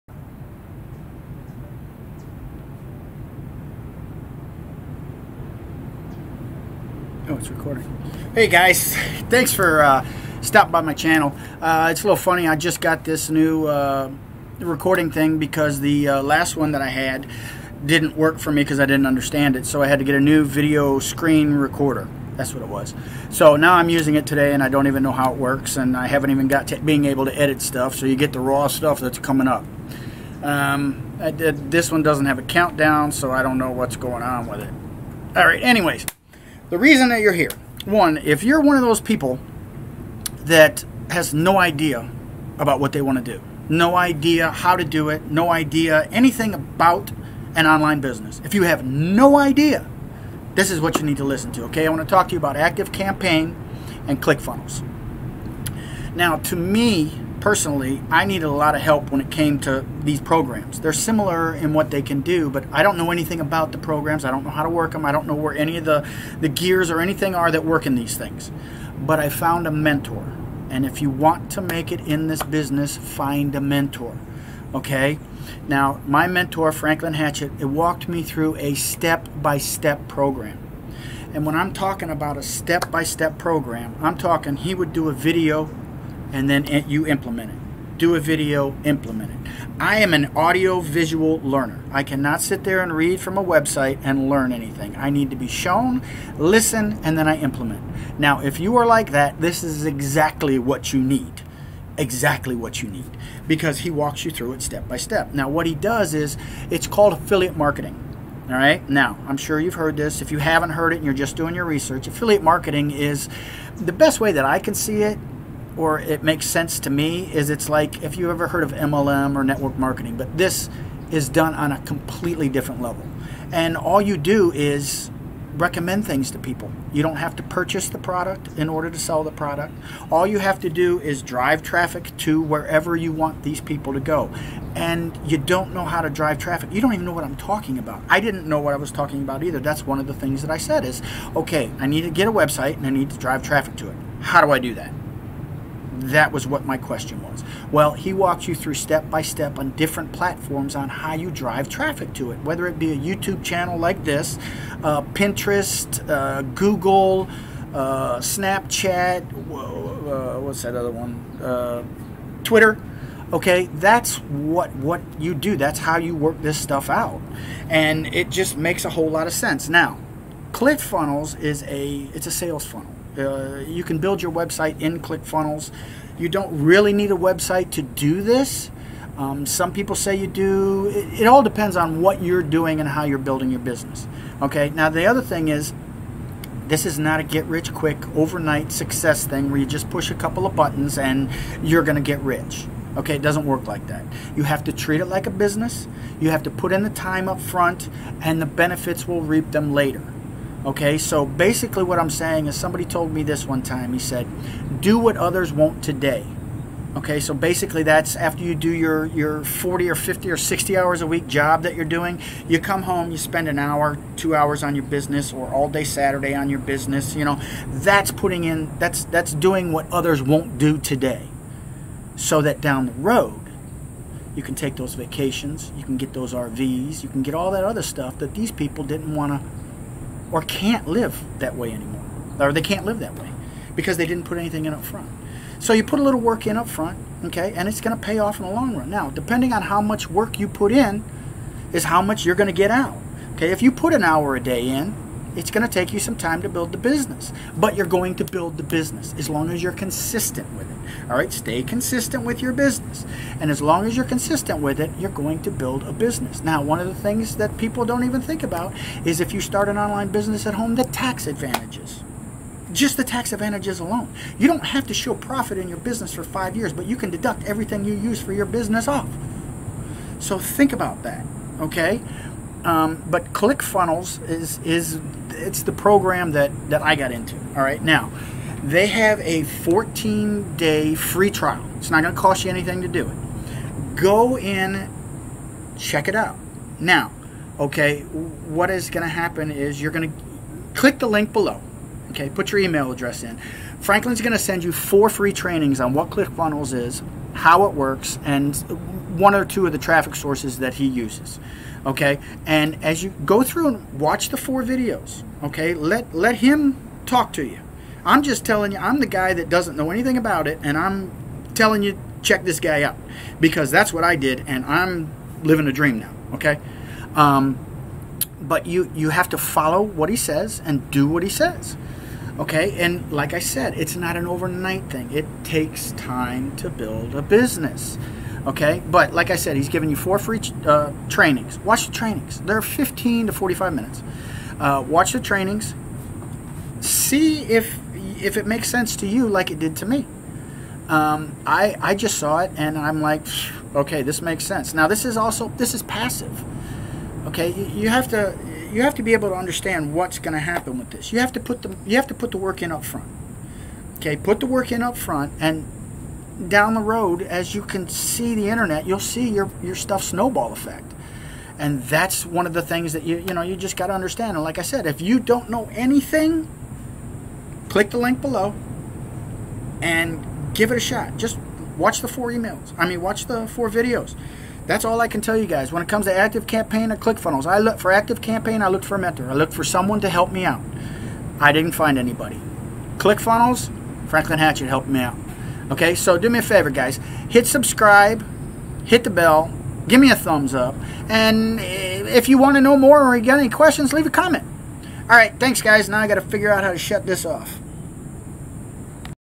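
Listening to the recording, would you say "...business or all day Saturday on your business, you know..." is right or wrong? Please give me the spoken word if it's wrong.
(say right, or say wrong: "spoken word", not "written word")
right.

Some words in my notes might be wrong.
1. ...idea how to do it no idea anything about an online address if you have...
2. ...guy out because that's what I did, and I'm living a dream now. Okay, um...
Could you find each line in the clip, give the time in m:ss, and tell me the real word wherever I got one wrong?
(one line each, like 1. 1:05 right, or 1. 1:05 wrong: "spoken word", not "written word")
1. 0:43 wrong: "business", not "address"
2. 5:12 right.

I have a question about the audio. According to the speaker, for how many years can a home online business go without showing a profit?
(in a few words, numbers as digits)
5.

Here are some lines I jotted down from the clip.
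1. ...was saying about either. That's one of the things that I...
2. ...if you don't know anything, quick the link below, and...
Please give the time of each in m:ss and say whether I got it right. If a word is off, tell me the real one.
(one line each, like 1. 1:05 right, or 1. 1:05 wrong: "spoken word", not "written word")
1. 2:18 wrong: "talking", not "saying"
2. 6:04 wrong: "click", not "quick".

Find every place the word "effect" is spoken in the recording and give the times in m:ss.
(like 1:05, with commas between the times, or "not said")
6:00.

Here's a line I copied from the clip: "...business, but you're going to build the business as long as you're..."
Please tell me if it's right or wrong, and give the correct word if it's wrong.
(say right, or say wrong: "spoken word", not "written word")
right.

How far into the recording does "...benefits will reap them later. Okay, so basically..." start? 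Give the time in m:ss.
3:18.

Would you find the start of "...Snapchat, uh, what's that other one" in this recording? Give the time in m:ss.
2:38.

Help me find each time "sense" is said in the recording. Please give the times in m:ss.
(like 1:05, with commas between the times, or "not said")
1:56, 2:49, 5:38, 5:44.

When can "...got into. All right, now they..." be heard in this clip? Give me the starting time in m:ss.
4:36.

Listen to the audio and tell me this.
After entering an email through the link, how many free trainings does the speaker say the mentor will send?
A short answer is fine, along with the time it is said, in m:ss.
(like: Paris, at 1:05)
4, at 4:54.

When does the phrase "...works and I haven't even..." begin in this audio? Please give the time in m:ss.
0:25.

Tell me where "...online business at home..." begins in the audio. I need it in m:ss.
4:19.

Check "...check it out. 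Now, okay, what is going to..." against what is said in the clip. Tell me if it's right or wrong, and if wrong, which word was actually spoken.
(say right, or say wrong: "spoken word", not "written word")
right.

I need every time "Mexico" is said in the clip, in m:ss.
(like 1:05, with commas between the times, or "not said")
not said.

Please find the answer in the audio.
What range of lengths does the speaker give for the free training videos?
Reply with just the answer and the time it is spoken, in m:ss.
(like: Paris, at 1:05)
15 to 45 minutes, at 5:32.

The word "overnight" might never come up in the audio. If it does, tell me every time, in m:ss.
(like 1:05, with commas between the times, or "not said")
3:08, 5:24.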